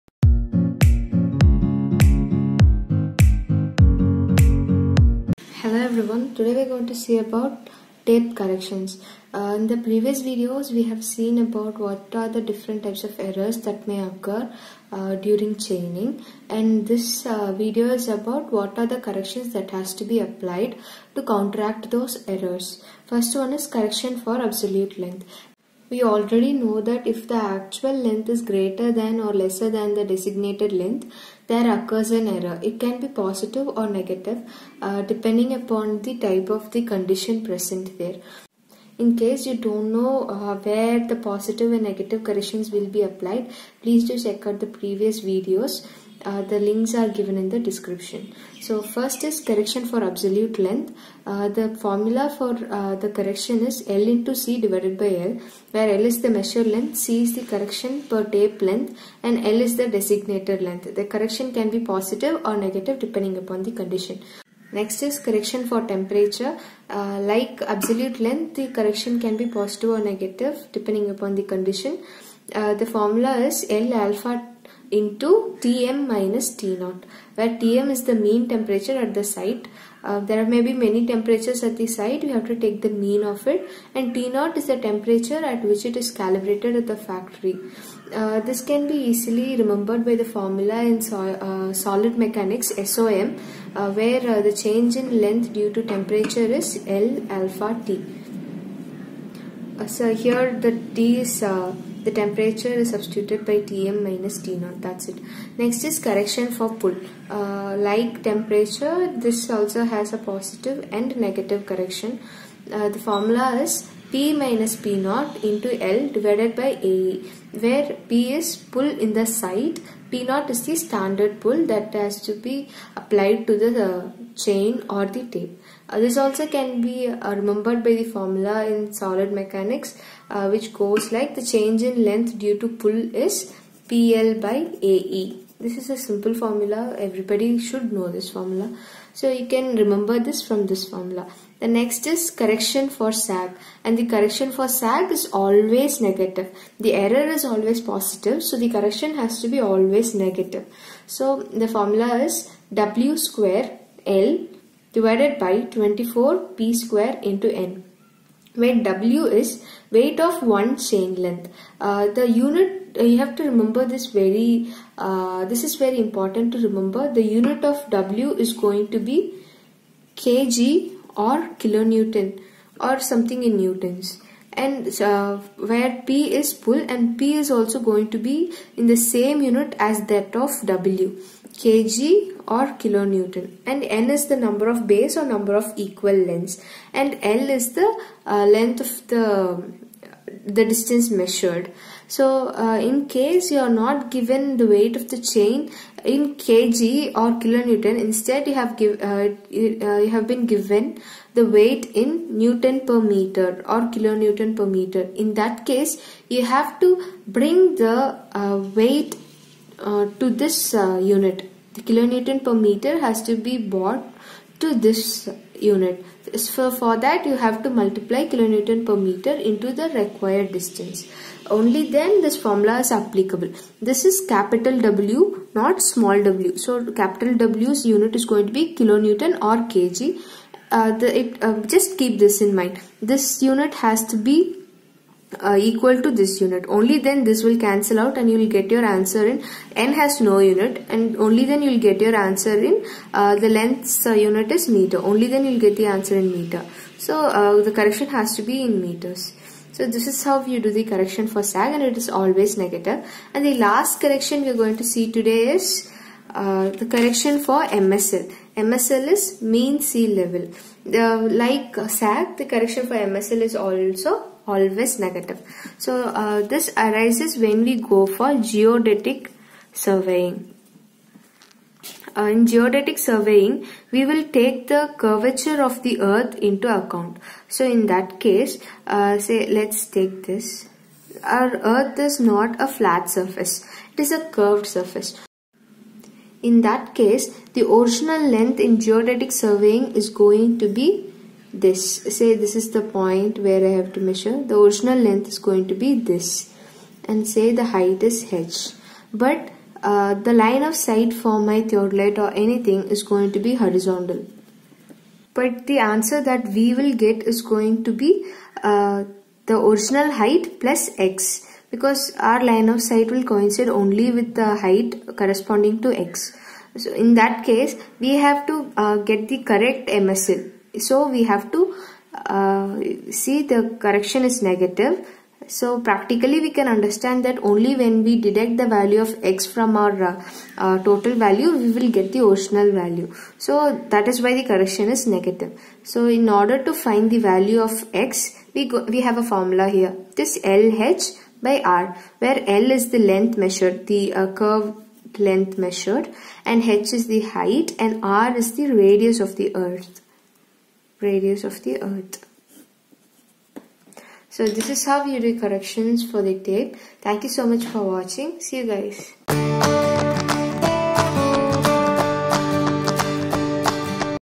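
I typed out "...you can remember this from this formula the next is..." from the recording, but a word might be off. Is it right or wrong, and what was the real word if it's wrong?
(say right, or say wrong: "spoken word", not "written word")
right.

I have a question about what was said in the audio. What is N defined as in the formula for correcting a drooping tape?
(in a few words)
number of bays.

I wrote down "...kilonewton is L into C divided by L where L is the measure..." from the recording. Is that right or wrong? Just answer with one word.
wrong.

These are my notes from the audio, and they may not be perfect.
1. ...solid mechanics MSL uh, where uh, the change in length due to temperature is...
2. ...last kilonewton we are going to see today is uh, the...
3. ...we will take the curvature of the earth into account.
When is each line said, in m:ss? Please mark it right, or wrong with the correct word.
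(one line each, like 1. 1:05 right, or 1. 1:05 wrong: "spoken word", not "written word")
1. 1:31 wrong: "SOM", not "MSL"
2. 4:13 wrong: "correction", not "kilonewton"
3. 4:33 right.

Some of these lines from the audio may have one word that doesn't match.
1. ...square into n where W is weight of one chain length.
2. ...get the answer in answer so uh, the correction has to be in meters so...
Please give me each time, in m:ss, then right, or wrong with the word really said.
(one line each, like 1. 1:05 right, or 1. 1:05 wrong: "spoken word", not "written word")
1. 2:36 right
2. 4:05 wrong: "meter", not "answer".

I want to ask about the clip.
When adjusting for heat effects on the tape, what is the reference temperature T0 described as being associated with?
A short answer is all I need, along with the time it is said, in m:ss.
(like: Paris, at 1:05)
calibrated at the factory, at 1:26.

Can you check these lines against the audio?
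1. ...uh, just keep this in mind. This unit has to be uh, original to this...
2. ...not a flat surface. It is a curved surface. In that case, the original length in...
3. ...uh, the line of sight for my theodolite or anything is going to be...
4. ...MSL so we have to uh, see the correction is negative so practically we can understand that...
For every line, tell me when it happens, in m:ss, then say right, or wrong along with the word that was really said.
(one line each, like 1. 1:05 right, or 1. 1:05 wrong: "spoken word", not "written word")
1. 3:51 wrong: "equal", not "original"
2. 4:42 right
3. 4:59 right
4. 5:19 right.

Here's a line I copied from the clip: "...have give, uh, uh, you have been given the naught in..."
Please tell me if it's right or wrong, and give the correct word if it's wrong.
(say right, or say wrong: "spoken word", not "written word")
wrong: "weight", not "naught".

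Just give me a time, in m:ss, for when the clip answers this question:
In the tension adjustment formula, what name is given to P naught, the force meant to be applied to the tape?
2:00.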